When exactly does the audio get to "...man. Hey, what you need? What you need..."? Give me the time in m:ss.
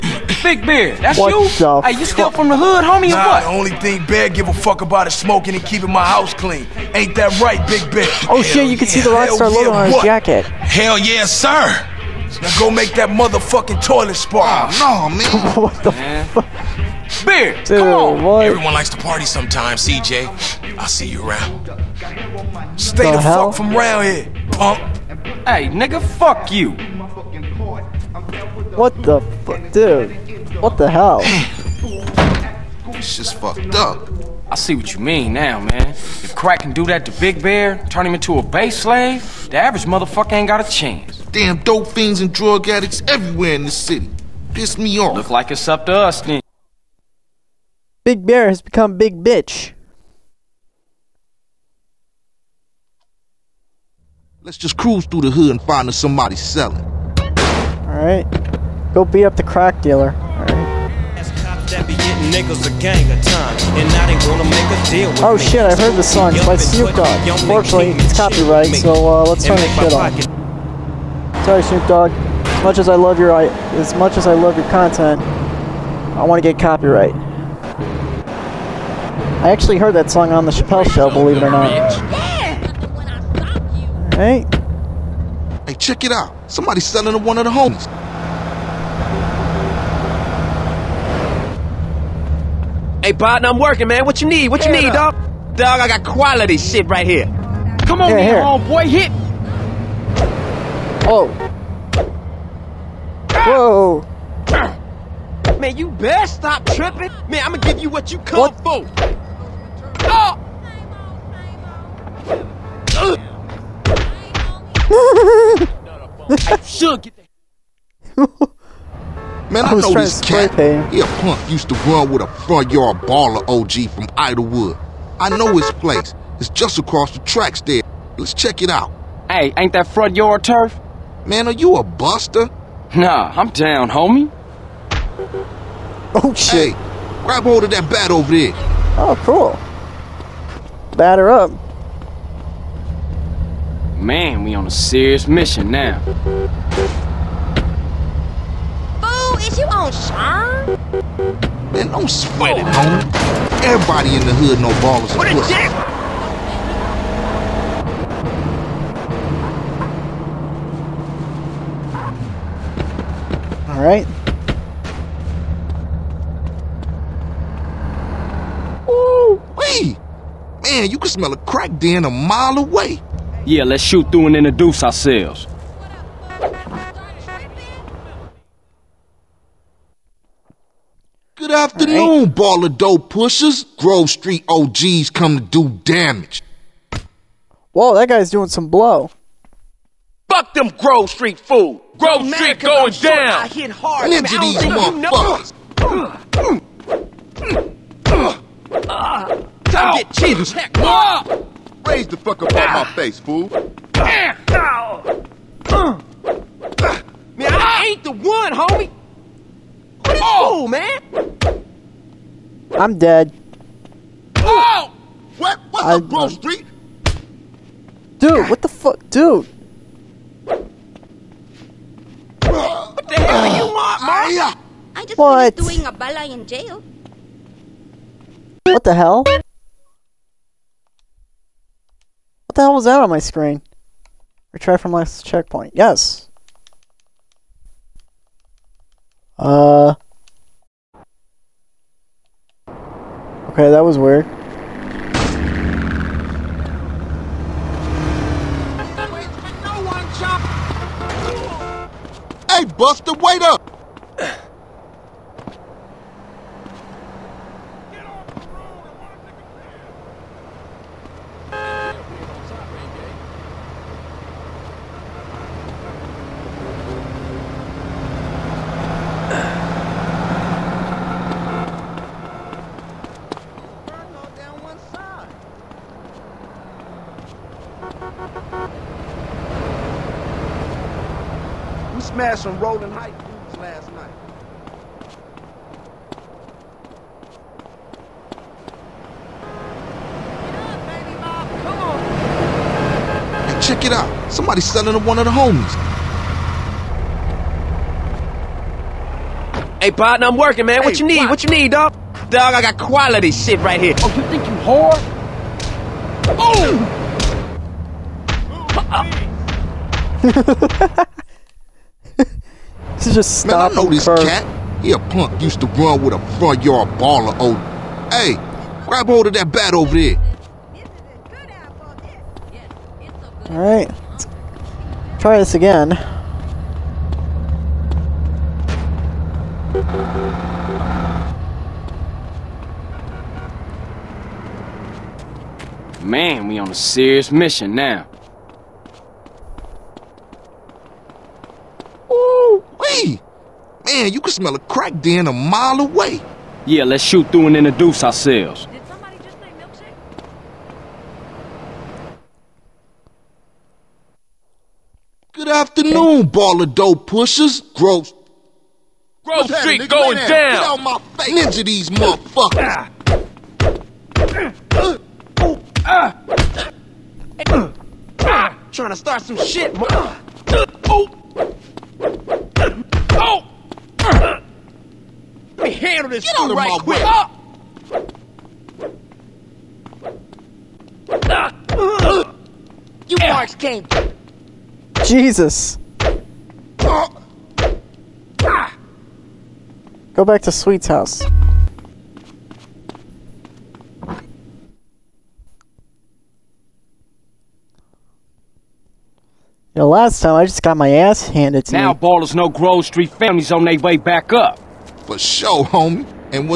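5:00.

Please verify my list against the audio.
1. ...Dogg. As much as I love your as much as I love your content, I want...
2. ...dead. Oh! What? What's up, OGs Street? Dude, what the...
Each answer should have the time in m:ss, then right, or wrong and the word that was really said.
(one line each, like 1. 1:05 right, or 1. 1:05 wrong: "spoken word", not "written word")
1. 1:11 right
2. 3:32 wrong: "Grove", not "OGs".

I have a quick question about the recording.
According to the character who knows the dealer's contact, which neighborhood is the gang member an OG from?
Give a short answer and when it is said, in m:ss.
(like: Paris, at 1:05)
Idlewood, at 2:04.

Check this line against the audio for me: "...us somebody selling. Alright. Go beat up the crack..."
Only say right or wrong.
right.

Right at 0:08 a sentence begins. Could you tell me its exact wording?
Oh, shit, you can see the Rockstar yeah, logo on his jacket.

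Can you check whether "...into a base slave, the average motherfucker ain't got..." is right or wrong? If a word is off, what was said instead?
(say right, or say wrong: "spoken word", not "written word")
right.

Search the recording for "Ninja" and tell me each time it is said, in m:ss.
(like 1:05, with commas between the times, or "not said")
3:14, 6:01.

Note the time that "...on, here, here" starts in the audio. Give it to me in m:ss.
1:38.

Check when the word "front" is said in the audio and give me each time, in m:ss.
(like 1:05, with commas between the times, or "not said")
2:02, 2:09, 5:16.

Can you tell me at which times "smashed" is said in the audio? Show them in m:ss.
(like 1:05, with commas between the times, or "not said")
4:42.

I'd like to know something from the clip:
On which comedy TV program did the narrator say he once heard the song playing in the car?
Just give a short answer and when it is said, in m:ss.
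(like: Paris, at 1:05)
Chappelle Show, at 1:20.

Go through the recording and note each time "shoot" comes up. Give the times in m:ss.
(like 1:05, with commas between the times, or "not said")
2:53, 5:47.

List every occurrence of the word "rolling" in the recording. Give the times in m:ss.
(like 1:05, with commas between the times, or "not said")
4:42.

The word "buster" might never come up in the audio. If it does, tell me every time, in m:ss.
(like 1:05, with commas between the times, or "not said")
2:11, 4:12.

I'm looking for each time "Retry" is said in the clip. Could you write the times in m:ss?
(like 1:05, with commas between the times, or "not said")
3:54.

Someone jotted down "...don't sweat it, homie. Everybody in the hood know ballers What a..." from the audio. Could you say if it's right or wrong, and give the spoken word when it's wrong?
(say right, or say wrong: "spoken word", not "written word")
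right.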